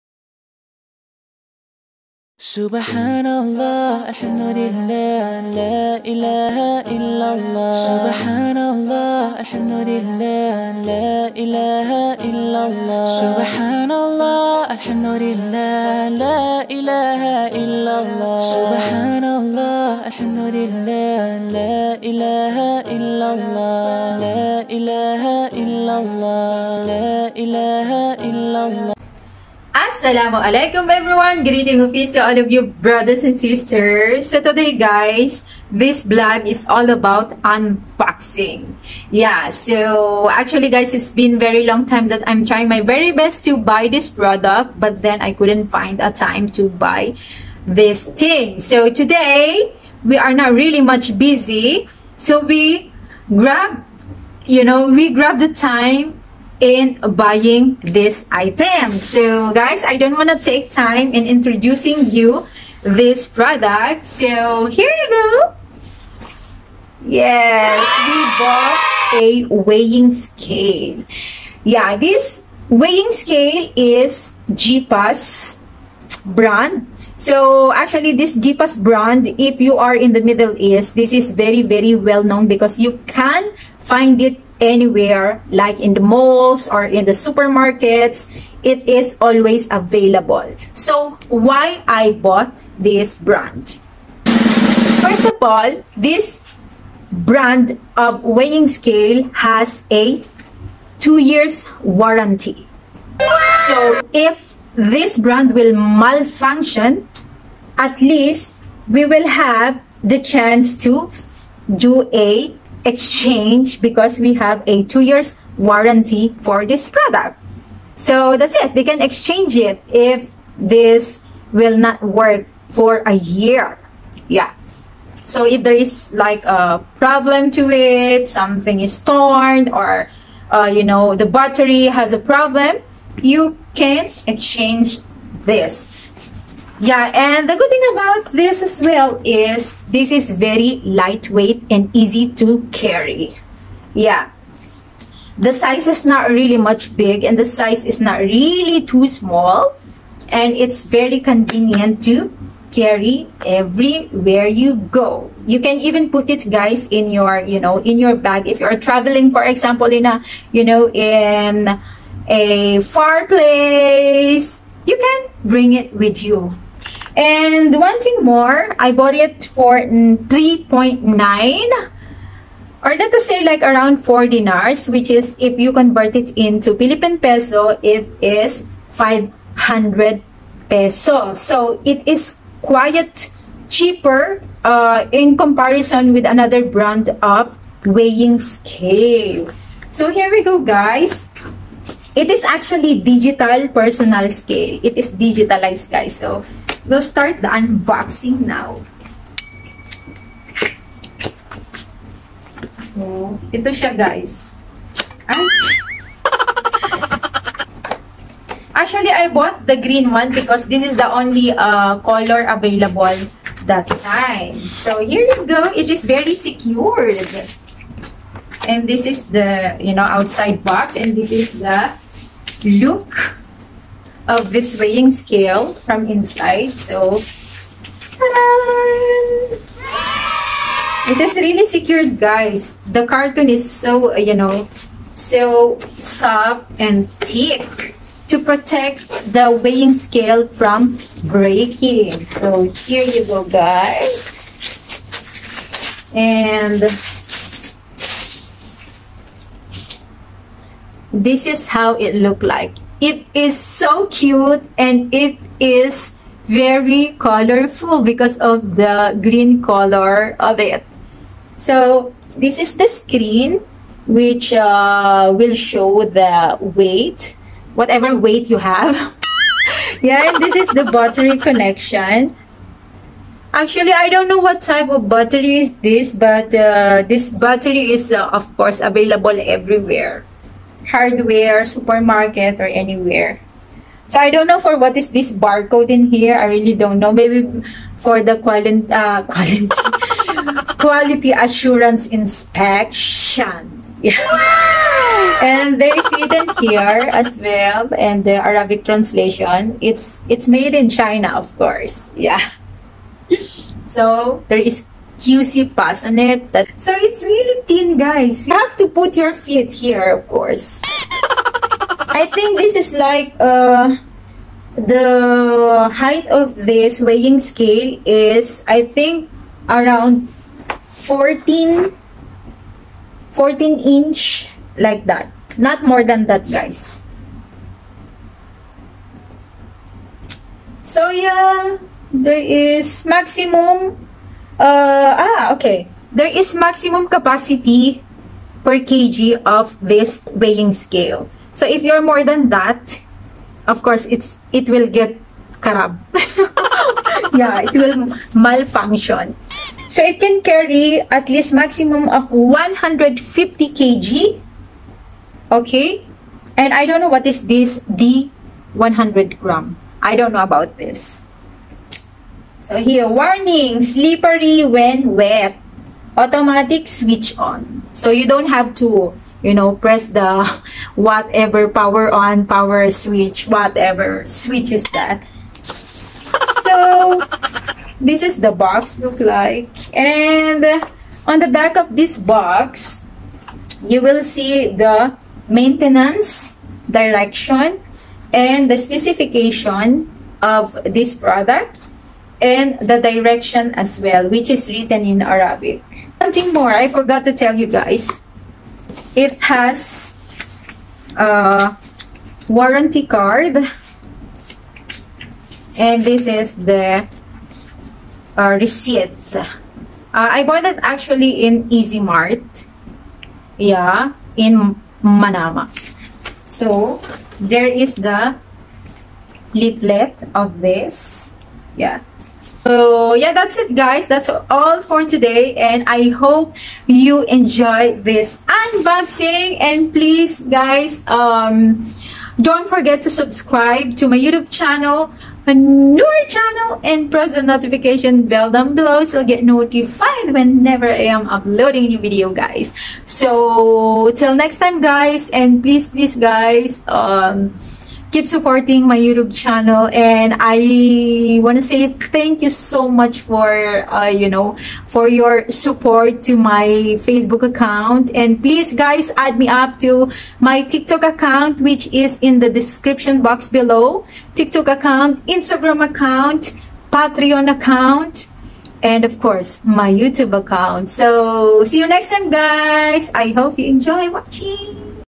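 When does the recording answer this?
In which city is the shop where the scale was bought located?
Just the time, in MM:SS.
06:55.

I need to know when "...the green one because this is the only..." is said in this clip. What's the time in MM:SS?
03:29.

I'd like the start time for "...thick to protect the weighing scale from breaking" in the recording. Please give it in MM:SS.
03:57.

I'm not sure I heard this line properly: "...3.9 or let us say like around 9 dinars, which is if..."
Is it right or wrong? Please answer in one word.
wrong.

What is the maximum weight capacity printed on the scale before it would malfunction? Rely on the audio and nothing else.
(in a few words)
150 kg.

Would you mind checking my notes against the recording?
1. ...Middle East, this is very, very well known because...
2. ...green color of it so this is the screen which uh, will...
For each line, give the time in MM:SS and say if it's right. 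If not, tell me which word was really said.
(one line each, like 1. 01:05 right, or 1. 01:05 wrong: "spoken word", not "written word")
1. 01:20 right
2. 04:19 right.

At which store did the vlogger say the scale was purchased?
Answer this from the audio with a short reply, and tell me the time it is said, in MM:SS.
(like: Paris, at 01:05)
Easy Mart, at 06:51.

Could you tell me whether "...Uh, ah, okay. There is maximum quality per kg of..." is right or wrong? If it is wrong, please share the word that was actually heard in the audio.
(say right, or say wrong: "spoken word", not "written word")
wrong: "capacity", not "quality".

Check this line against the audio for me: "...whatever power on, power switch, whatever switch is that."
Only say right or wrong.
right.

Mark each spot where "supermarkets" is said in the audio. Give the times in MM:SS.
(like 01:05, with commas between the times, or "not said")
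01:27, 04:41.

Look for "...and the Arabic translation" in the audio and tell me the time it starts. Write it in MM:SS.
04:57.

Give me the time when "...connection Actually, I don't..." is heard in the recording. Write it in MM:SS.
04:31.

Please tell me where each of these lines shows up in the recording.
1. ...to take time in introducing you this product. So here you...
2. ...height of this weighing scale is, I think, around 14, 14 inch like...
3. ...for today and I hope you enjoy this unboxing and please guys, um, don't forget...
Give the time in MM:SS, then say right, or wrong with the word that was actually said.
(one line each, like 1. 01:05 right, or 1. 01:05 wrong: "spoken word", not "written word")
1. 01:00 right
2. 05:15 right
3. 07:04 right.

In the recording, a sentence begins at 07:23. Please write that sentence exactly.
So till next time guys and please please guys, um, keep supporting my YouTube channel.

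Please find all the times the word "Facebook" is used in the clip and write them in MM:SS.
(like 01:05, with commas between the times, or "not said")
07:37.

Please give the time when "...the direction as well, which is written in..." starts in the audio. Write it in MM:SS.
06:32.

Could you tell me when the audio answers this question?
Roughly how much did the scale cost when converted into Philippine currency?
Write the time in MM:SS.
02:58.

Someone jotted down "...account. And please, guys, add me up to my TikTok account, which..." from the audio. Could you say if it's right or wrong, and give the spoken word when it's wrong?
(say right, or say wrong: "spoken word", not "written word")
right.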